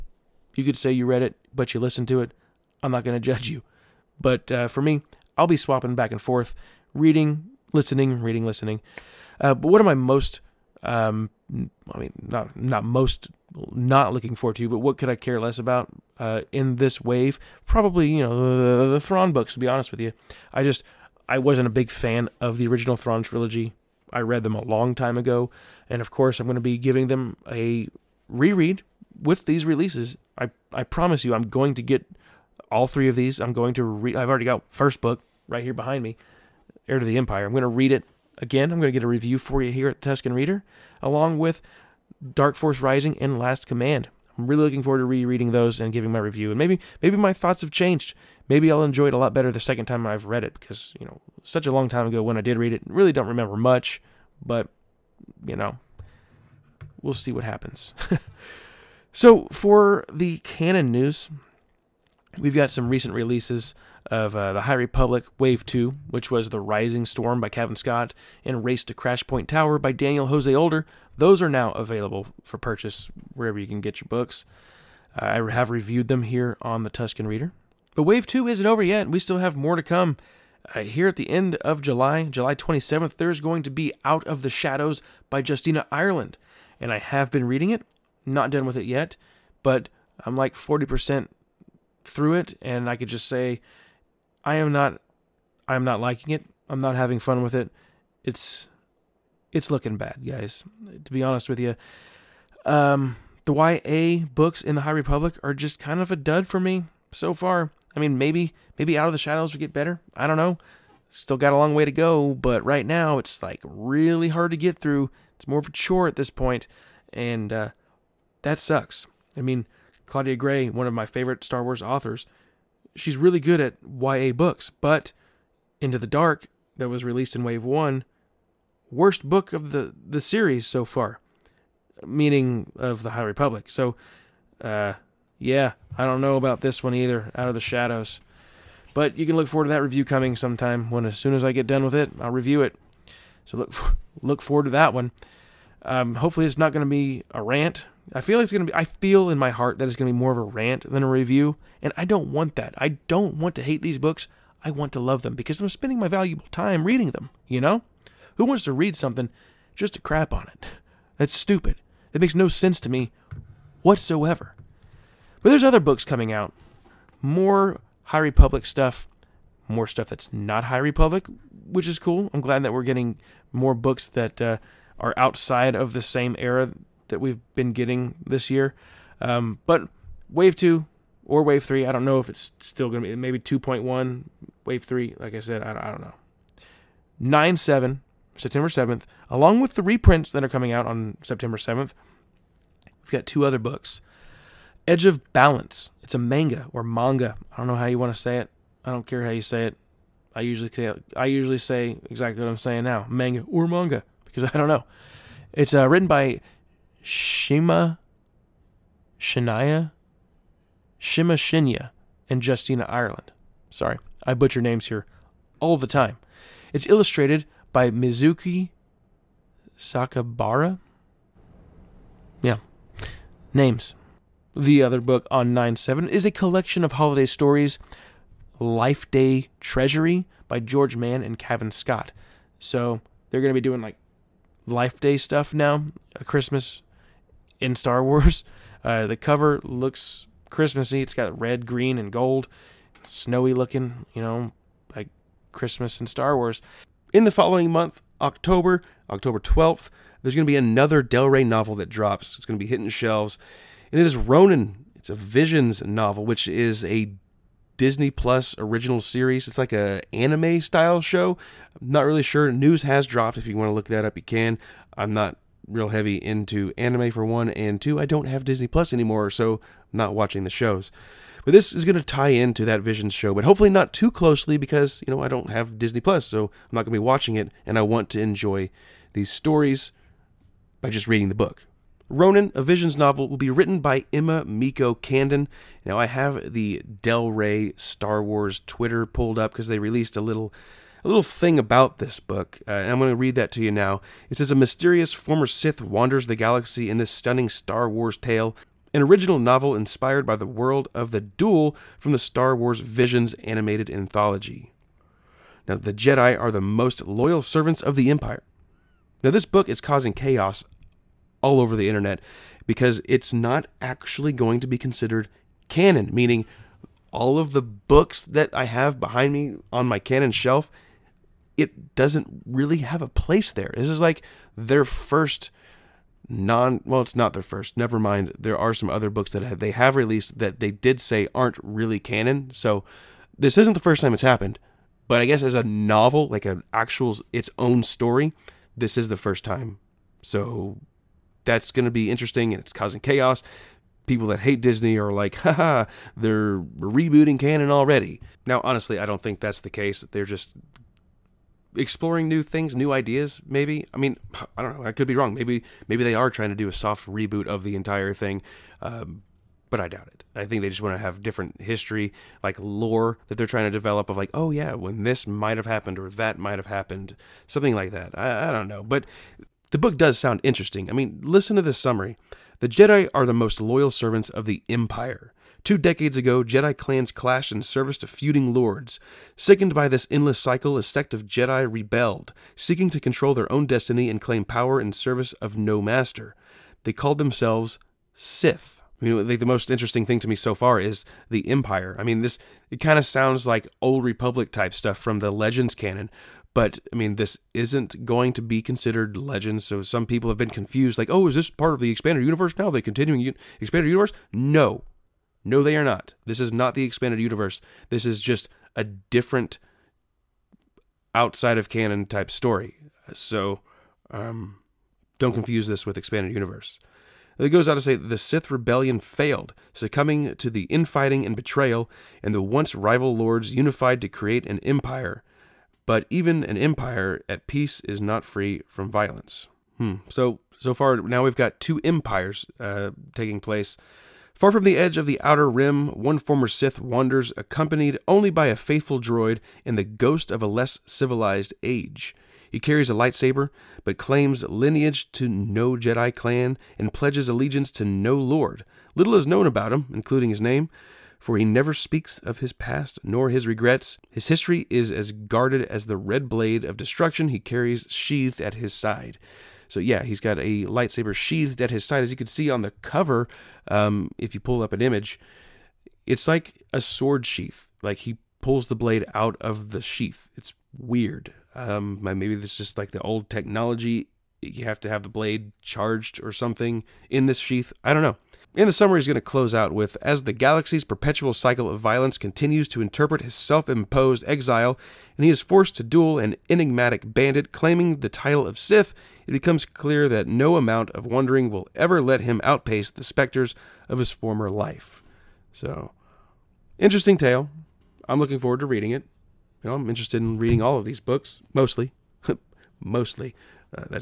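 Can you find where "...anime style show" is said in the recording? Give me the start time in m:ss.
4:20.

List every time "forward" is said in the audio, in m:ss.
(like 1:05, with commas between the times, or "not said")
0:14, 0:44, 2:19, 2:24, 8:18.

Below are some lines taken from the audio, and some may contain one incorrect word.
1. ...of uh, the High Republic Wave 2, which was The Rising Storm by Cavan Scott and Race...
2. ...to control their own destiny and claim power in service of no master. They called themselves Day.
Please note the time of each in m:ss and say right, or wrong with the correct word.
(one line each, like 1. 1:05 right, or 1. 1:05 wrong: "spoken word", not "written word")
1. 1:04 right
2. 6:22 wrong: "Sith", not "Day".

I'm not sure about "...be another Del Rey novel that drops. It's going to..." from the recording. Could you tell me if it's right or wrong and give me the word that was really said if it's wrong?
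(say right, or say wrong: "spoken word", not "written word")
right.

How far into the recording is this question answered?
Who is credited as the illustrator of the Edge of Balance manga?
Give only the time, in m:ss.
3:37.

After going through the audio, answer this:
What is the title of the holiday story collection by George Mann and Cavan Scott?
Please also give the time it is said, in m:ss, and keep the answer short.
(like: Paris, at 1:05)
Life Day Treasury, at 3:48.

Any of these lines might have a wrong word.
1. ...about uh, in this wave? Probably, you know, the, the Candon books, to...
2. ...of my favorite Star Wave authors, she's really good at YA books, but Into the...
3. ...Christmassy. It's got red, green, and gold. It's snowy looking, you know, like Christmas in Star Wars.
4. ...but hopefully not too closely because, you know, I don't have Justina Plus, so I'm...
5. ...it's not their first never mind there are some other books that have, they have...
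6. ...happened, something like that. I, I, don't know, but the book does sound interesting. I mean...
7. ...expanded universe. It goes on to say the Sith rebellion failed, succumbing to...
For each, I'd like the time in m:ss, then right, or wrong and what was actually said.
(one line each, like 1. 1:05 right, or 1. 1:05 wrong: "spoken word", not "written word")
1. 0:15 wrong: "Thrawn", not "Candon"
2. 2:00 wrong: "Wars", not "Wave"
3. 4:00 right
4. 4:33 wrong: "Disney", not "Justina"
5. 5:27 right
6. 6:06 right
7. 6:55 right.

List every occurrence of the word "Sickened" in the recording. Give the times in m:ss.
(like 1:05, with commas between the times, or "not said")
6:19.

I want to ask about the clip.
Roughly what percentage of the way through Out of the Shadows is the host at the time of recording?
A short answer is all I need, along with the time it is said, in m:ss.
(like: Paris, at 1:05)
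40%, at 1:30.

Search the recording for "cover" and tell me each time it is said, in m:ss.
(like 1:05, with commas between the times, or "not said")
3:59, 7:42.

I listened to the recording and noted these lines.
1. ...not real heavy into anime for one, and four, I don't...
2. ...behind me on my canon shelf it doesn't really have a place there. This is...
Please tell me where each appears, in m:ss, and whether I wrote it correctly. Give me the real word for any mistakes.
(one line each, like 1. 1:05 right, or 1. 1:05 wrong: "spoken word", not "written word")
1. 4:25 wrong: "two", not "four"
2. 5:18 right.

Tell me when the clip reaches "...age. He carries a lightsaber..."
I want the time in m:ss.
7:21.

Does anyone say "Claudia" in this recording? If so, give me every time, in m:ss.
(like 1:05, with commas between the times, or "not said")
2:00.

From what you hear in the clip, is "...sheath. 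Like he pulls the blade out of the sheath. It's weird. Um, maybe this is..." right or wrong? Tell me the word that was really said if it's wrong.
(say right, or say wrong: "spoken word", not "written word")
right.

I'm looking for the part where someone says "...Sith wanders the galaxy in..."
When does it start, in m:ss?
4:55.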